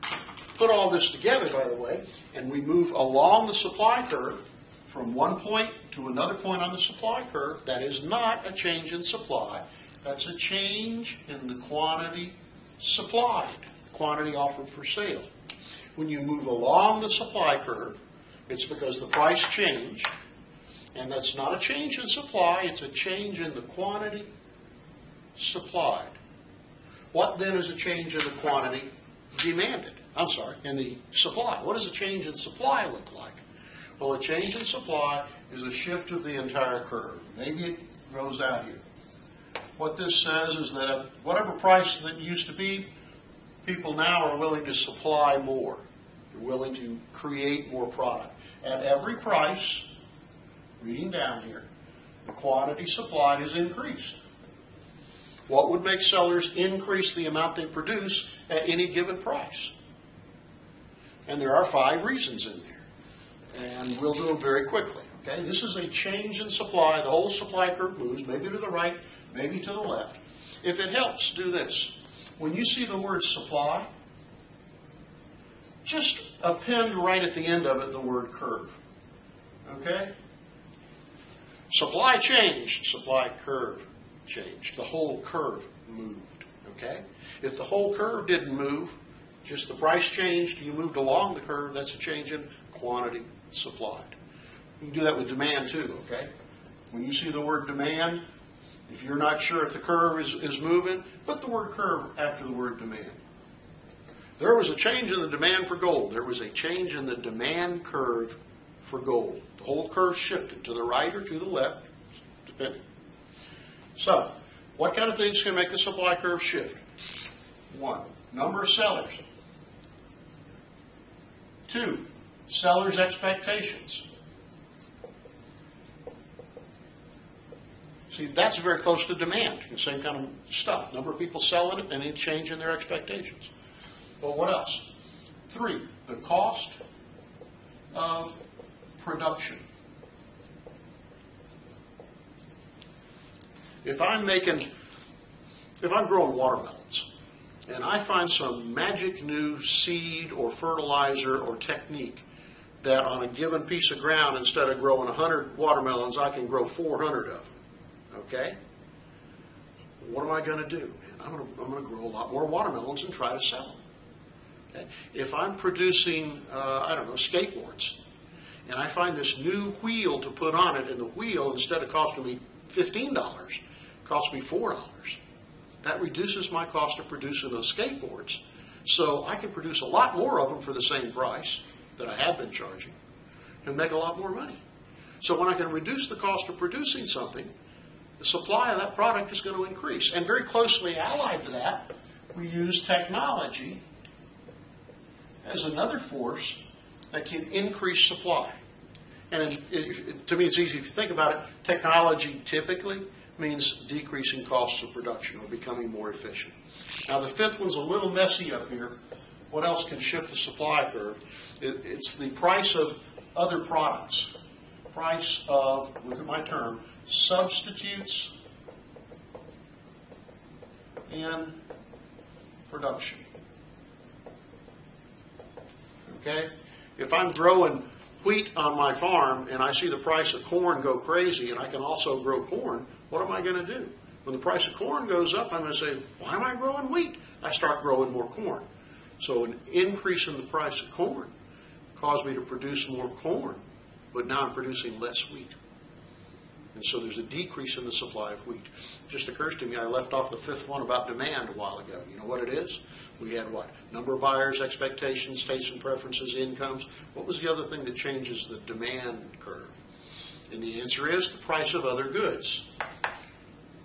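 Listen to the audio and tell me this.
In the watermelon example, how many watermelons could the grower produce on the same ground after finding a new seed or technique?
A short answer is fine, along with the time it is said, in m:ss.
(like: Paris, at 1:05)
400, at 2:36.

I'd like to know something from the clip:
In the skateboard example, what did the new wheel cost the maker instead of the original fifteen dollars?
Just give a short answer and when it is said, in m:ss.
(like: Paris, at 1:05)
$4, at 2:54.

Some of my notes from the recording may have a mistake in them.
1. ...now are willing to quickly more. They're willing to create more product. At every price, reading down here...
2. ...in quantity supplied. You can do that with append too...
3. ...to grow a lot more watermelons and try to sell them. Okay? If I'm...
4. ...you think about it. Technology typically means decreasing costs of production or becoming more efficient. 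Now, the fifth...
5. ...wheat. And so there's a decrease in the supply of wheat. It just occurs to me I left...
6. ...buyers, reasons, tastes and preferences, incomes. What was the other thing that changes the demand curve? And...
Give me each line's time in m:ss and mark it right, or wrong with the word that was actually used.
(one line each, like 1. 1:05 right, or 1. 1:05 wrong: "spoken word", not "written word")
1. 0:43 wrong: "supply", not "quickly"
2. 1:32 wrong: "demand", not "append"
3. 2:41 right
4. 3:20 right
5. 4:05 right
6. 4:14 wrong: "expectations", not "reasons".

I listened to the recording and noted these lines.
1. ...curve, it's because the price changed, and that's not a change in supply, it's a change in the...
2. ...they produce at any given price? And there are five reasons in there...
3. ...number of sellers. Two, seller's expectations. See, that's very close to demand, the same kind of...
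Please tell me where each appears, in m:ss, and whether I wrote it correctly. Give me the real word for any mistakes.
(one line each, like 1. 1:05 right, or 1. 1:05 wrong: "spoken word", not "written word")
1. 0:17 right
2. 0:57 right
3. 1:58 right.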